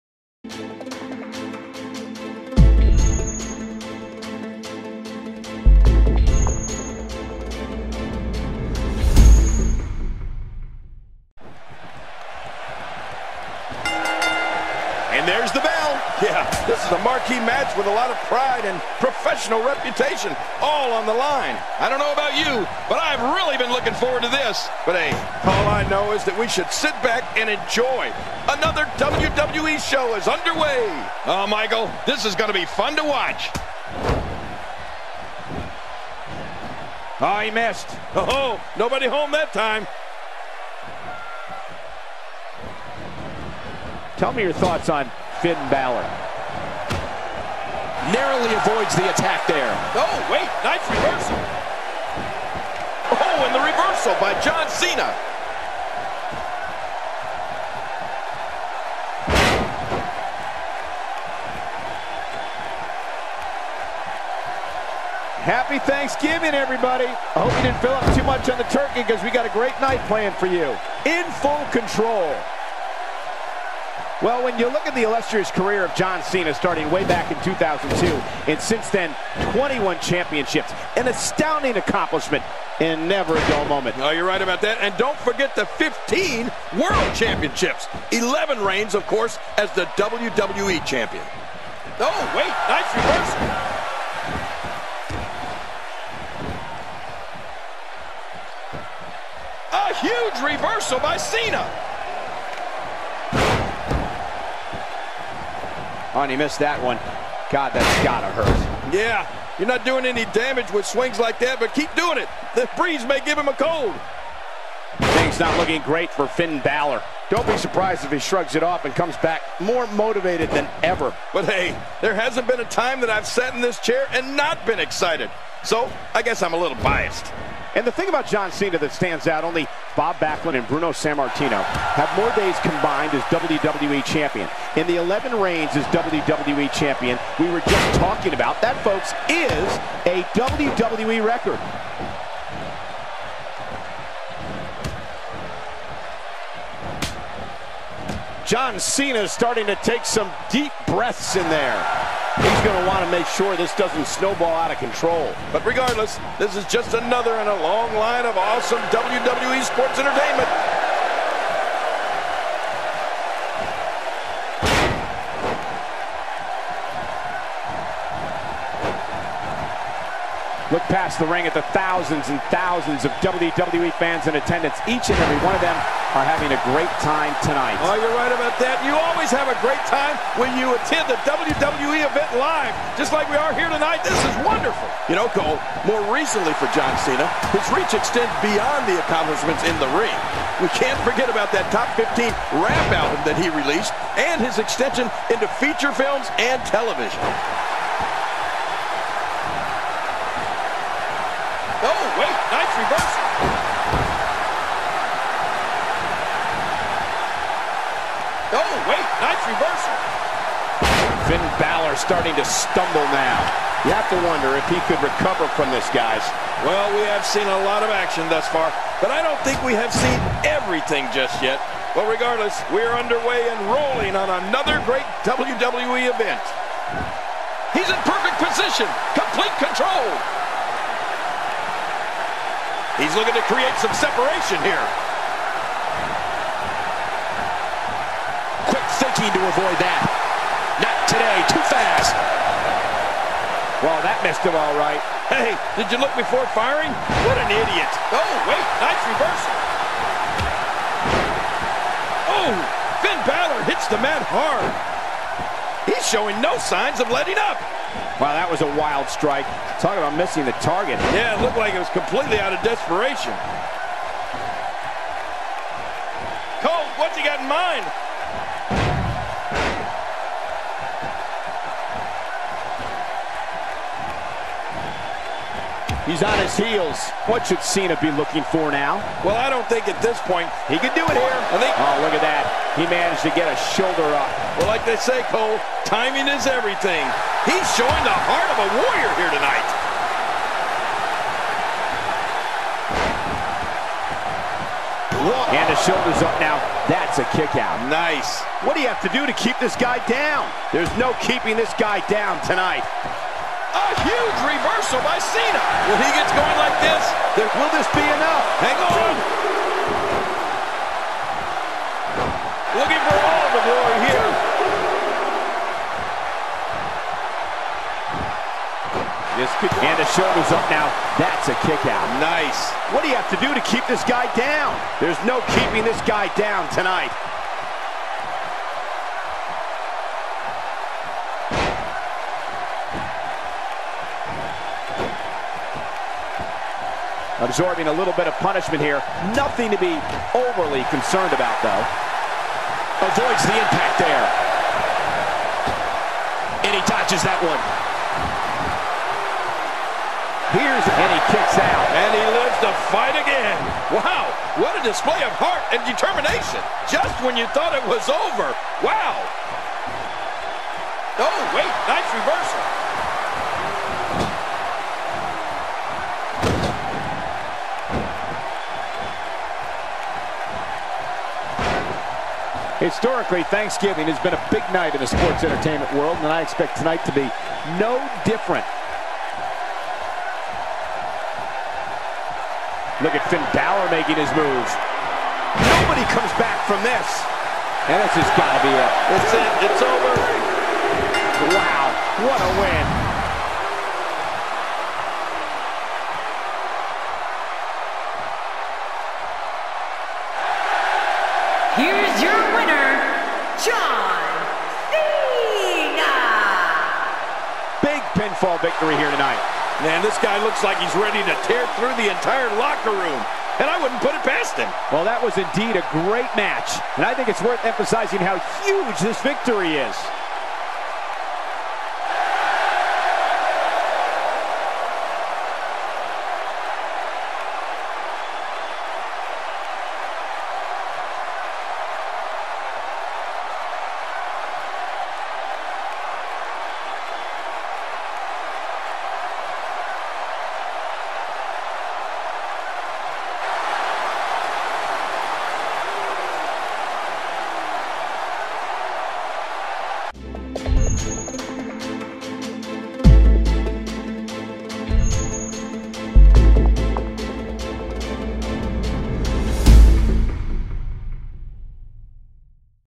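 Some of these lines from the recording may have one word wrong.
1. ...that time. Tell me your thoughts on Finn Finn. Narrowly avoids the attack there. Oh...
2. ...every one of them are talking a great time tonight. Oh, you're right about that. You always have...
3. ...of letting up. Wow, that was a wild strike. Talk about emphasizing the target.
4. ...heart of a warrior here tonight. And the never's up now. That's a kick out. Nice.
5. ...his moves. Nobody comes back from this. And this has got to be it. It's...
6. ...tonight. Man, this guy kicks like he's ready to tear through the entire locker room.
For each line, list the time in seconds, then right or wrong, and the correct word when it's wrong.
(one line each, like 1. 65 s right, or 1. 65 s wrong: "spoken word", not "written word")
1. 39 s wrong: "Balor", not "Finn"
2. 175 s wrong: "having", not "talking"
3. 257 s wrong: "missing", not "emphasizing"
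4. 288 s wrong: "shoulder", not "never"
5. 384 s right
6. 409 s wrong: "looks", not "kicks".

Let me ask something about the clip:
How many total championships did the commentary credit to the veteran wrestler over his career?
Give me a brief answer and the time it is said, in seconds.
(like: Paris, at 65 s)
21, at 79 s.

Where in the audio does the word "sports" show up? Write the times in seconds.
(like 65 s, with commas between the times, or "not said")
159 s, 375 s.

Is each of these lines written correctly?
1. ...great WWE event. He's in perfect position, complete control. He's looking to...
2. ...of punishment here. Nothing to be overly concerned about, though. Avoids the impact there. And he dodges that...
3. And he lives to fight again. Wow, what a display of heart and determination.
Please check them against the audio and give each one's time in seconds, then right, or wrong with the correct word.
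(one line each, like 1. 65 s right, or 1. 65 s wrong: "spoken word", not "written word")
1. 224 s right
2. 338 s right
3. 351 s right.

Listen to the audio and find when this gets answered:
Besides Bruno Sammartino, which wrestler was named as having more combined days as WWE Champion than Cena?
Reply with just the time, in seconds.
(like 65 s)
129 s.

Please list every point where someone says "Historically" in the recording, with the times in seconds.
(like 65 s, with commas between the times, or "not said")
372 s.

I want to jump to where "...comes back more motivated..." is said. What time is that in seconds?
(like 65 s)
118 s.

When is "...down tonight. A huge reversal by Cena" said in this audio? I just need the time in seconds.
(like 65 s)
302 s.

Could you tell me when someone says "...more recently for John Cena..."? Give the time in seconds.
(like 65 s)
185 s.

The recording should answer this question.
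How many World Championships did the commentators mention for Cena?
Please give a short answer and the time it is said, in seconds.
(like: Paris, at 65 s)
15, at 85 s.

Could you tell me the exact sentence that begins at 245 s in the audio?
Hey, did you look before firing?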